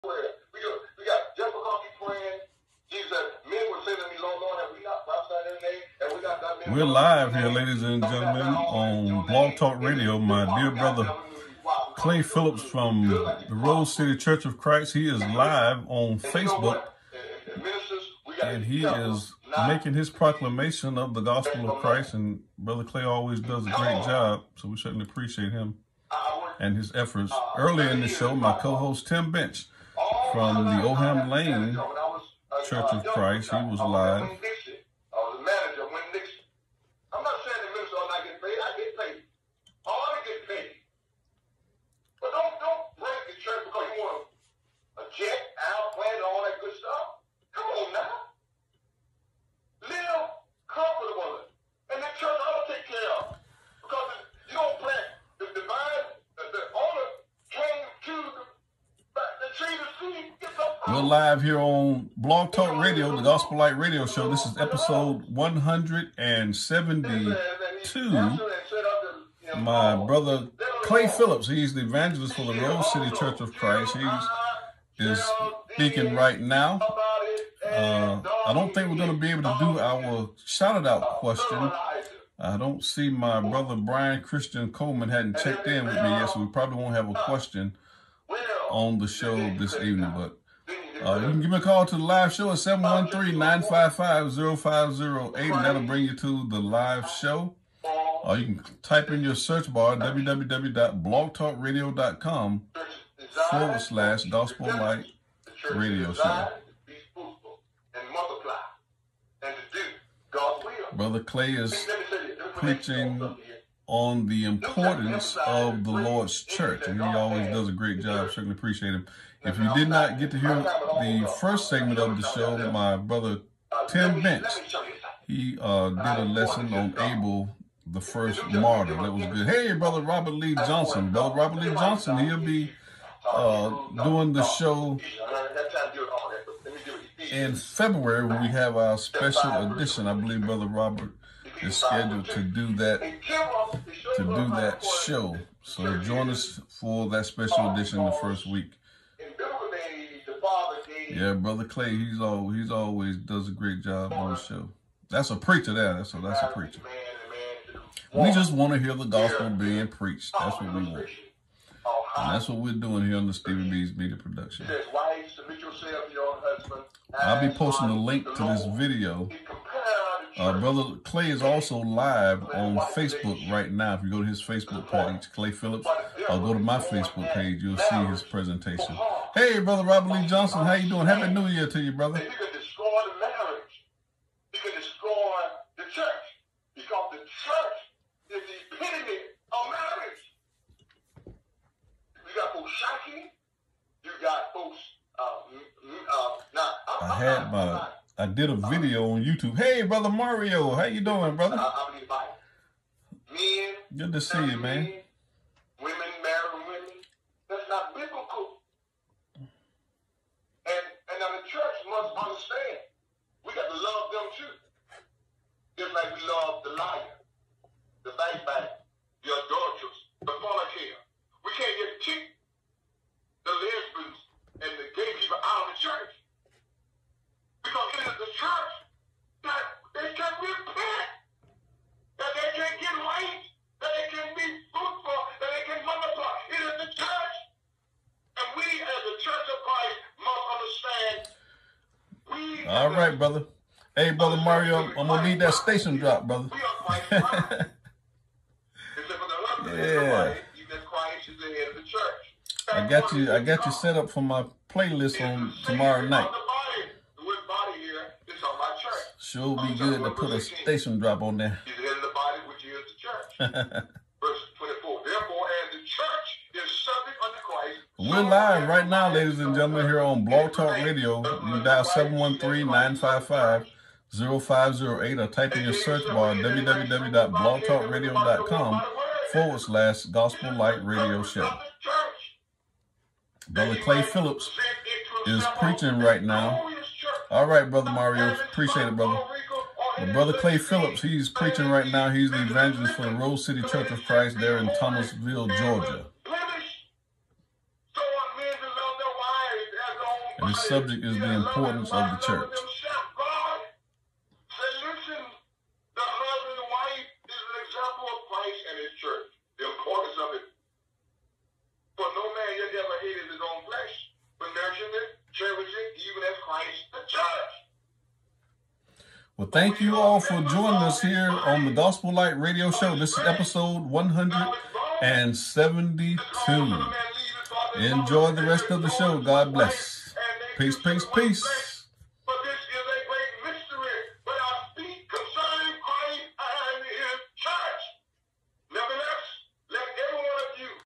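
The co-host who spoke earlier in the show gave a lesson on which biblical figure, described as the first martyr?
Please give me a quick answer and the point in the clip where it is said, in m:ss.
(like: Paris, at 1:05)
Abel, at 2:06.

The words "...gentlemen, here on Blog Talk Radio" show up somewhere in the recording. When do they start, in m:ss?
4:29.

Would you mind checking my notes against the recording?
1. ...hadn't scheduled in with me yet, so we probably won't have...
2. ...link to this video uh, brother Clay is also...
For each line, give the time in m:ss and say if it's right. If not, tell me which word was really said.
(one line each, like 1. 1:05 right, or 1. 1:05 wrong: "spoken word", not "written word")
1. 1:25 wrong: "checked", not "scheduled"
2. 2:47 right.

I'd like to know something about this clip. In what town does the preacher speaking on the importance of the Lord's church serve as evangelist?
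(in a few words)
Thomasville, Georgia.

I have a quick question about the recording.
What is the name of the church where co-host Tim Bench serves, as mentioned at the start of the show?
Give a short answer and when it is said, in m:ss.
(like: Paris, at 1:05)
Oham Lane Church of Christ, at 0:30.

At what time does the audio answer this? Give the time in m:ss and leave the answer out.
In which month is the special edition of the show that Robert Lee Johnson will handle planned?
2:17.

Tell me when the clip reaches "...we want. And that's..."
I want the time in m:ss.
2:40.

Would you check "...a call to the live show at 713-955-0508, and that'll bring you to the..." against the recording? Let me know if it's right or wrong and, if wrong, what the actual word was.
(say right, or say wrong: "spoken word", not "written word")
right.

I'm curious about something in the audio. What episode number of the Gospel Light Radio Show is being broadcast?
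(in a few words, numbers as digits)
172.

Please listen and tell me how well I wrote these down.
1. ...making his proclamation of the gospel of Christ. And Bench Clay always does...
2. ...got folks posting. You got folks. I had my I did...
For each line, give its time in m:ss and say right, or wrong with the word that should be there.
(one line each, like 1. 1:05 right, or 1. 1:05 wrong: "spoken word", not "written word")
1. 0:19 wrong: "Brother", not "Bench"
2. 3:12 wrong: "shocking", not "posting".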